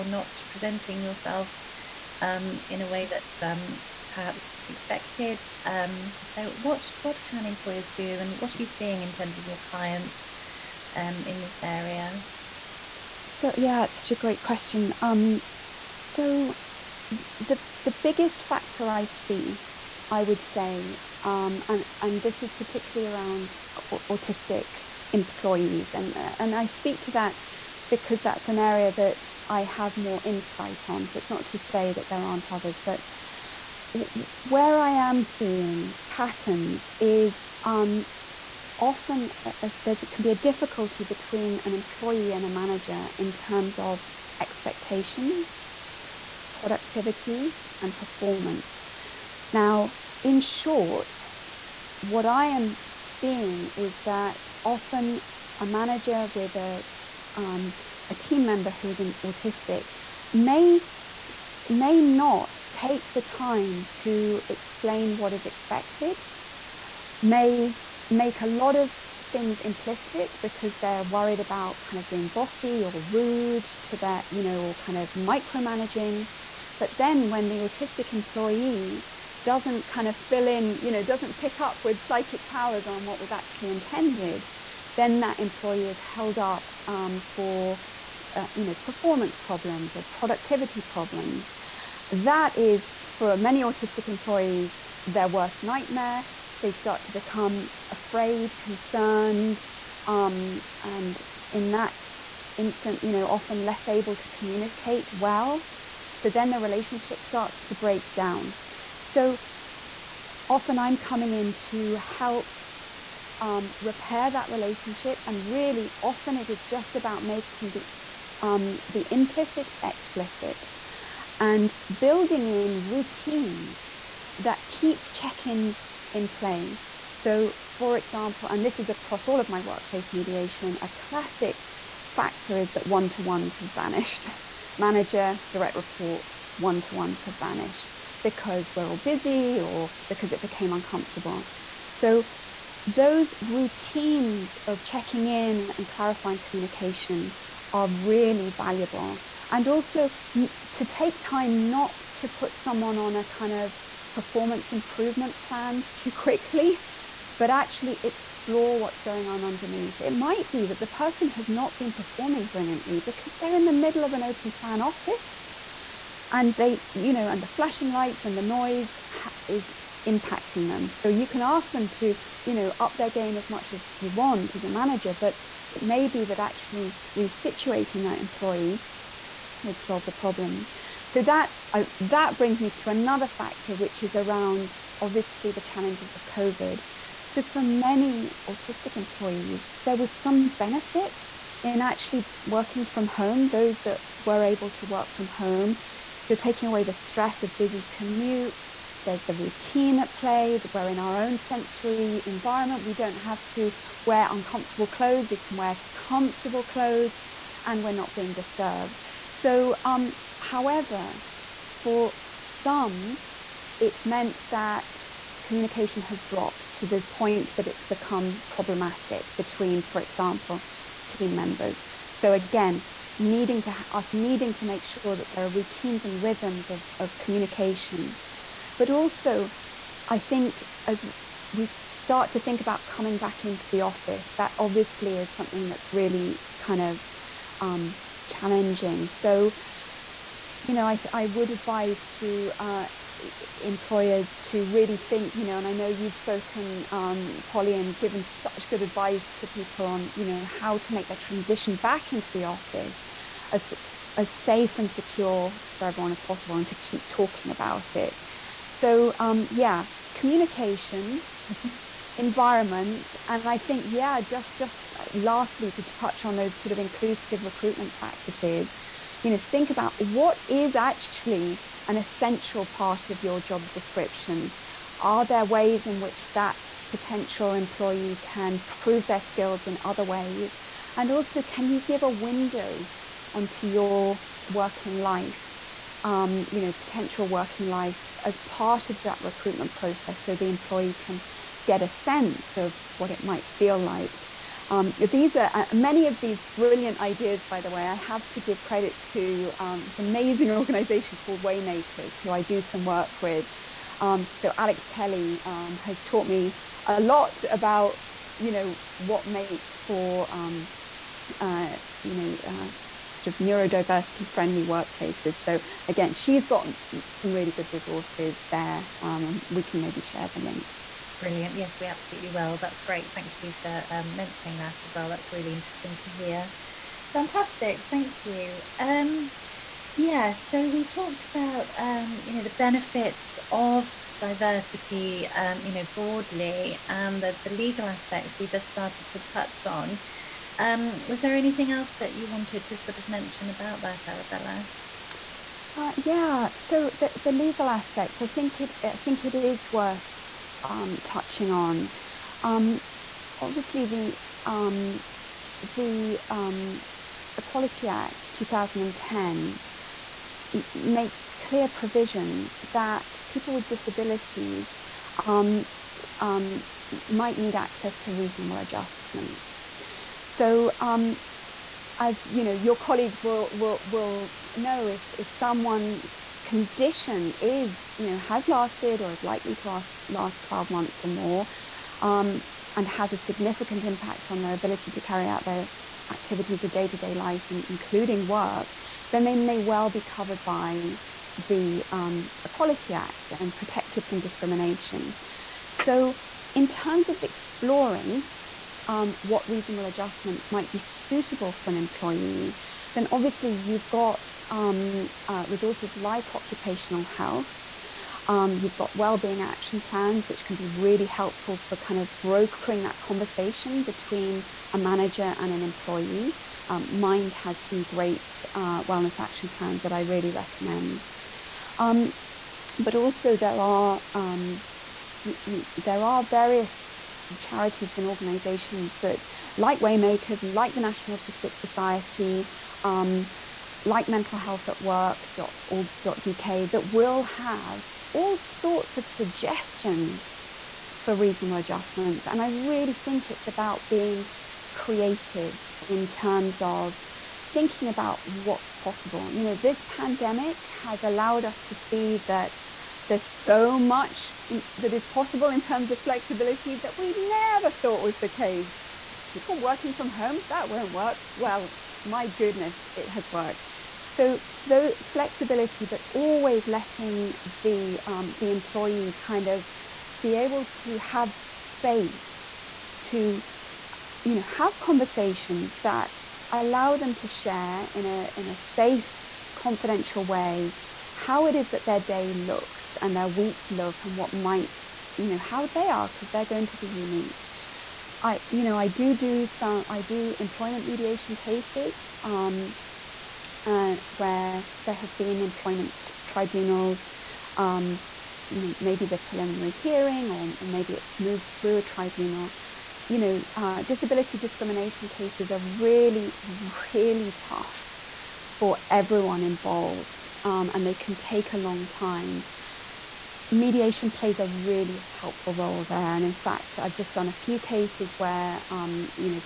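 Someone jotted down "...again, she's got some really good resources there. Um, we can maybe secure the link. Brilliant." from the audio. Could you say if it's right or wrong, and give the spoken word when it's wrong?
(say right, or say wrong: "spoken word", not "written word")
wrong: "share", not "secure".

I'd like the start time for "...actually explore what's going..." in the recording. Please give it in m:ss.
2:37.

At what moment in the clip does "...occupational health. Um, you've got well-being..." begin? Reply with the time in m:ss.
6:46.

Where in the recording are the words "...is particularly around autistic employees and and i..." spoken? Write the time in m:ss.
0:22.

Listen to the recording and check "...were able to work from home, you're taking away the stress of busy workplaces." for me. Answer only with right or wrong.
wrong.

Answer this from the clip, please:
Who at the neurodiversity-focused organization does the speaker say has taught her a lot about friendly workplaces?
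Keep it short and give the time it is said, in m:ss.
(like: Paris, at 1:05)
Alex Kelly, at 5:04.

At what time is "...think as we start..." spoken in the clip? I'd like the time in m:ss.
3:50.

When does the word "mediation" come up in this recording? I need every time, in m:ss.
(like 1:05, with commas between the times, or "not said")
2:10, 8:10, 8:33.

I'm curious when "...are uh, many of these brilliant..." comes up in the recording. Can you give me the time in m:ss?
4:55.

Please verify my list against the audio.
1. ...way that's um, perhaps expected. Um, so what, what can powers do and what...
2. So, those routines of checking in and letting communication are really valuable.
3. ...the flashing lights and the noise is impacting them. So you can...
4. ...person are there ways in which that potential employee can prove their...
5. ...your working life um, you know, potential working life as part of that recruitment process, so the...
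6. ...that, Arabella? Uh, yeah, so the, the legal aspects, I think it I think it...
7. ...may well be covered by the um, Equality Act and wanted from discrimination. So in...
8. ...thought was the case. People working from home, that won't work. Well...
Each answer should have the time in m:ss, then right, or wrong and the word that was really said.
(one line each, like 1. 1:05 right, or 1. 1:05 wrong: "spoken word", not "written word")
1. 0:02 wrong: "employers", not "powers"
2. 2:21 wrong: "clarifying", not "letting"
3. 2:47 right
4. 4:33 wrong: "description", not "person"
5. 4:43 right
6. 5:43 right
7. 6:29 wrong: "protected", not "wanted"
8. 7:37 right.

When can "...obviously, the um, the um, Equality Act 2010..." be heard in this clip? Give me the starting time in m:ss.
5:53.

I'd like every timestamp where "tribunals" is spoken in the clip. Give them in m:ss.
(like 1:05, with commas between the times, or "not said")
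8:16, 8:21.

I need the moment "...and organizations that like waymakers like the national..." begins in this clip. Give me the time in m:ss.
7:07.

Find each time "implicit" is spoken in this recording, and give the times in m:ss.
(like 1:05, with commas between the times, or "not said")
1:09, 1:59.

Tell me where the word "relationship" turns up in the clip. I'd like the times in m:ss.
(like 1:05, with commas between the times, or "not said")
1:46, 1:54.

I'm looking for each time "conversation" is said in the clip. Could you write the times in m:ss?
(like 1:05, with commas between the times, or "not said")
6:52, 7:54.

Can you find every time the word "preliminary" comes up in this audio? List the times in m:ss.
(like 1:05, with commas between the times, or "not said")
8:19.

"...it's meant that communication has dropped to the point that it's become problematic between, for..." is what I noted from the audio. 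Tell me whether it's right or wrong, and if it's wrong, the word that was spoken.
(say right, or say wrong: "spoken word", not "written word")
right.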